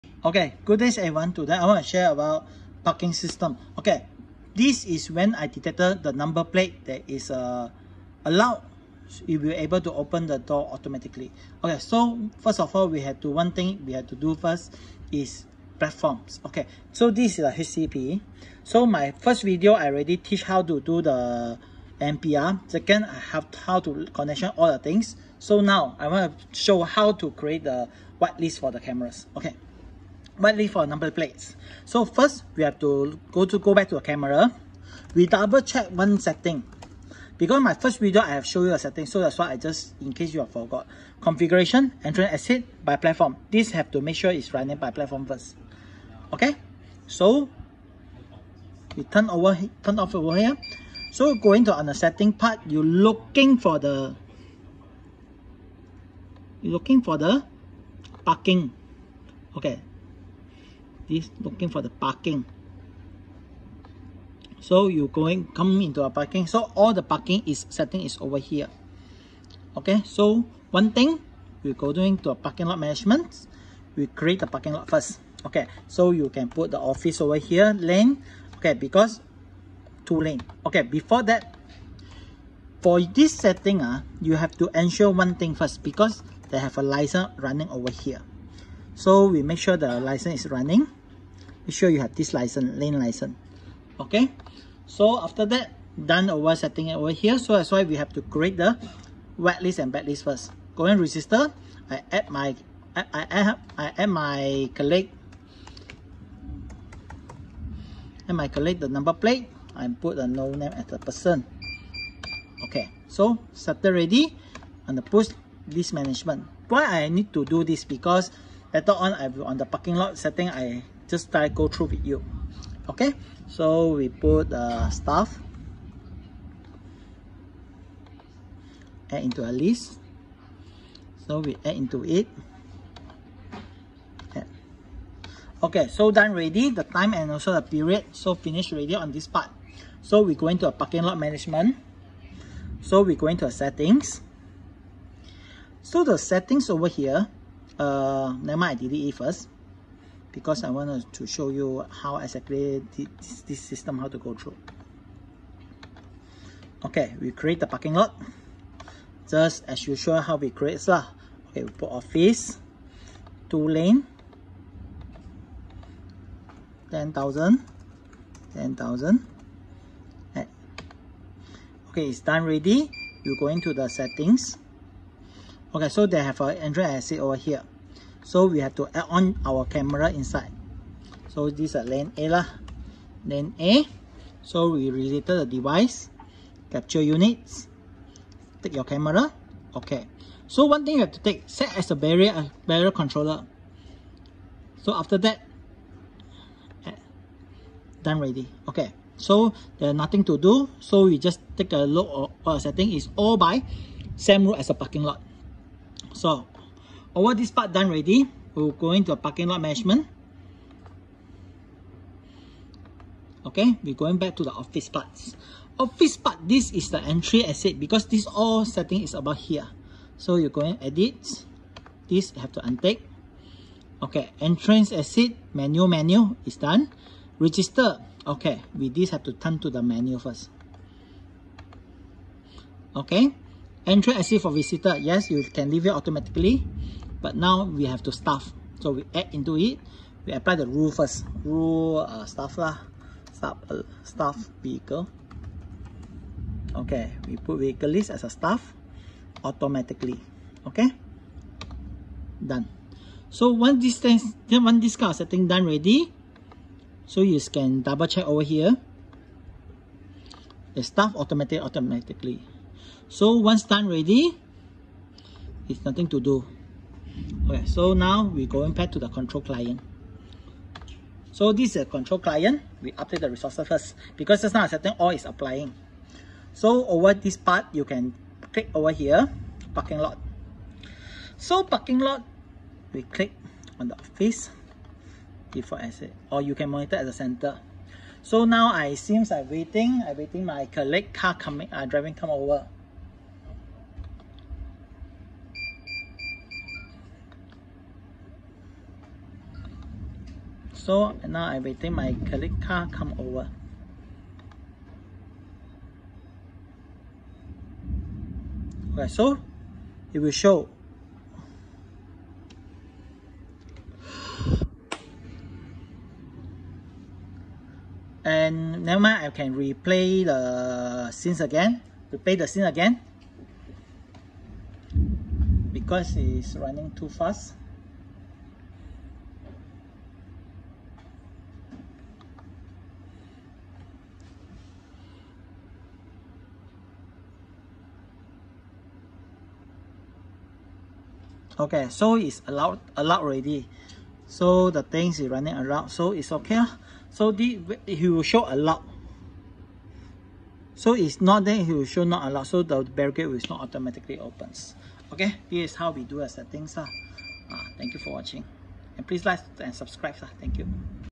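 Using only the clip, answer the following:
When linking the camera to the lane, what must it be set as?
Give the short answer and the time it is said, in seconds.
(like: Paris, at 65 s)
barrier controller, at 192 s.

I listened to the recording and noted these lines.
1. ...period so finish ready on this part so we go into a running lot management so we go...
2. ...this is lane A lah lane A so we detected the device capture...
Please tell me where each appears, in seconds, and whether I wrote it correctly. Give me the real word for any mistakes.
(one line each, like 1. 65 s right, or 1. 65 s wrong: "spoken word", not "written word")
1. 137 s wrong: "parking", not "running"
2. 181 s wrong: "related", not "detected".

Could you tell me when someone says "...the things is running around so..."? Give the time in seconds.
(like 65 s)
344 s.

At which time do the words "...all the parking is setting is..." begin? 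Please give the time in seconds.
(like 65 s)
66 s.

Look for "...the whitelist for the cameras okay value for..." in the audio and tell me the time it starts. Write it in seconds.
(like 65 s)
27 s.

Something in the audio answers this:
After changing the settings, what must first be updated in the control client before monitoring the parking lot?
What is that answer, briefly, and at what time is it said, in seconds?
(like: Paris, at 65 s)
resources, at 273 s.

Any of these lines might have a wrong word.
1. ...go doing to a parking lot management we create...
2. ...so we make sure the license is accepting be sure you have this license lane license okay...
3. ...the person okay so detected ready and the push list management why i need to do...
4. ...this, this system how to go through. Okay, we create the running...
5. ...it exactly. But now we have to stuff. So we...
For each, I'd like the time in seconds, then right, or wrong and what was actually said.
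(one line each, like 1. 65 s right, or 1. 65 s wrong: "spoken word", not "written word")
1. 71 s right
2. 88 s wrong: "running", not "accepting"
3. 110 s wrong: "started", not "detected"
4. 152 s wrong: "parking", not "running"
5. 235 s wrong: "automatically", not "exactly".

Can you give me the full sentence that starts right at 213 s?
Okay, we're going back to the office parts.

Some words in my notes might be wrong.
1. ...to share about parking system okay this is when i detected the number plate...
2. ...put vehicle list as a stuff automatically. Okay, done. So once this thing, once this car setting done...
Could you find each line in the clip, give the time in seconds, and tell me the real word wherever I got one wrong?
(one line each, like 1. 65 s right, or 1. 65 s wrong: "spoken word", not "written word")
1. 1 s right
2. 247 s right.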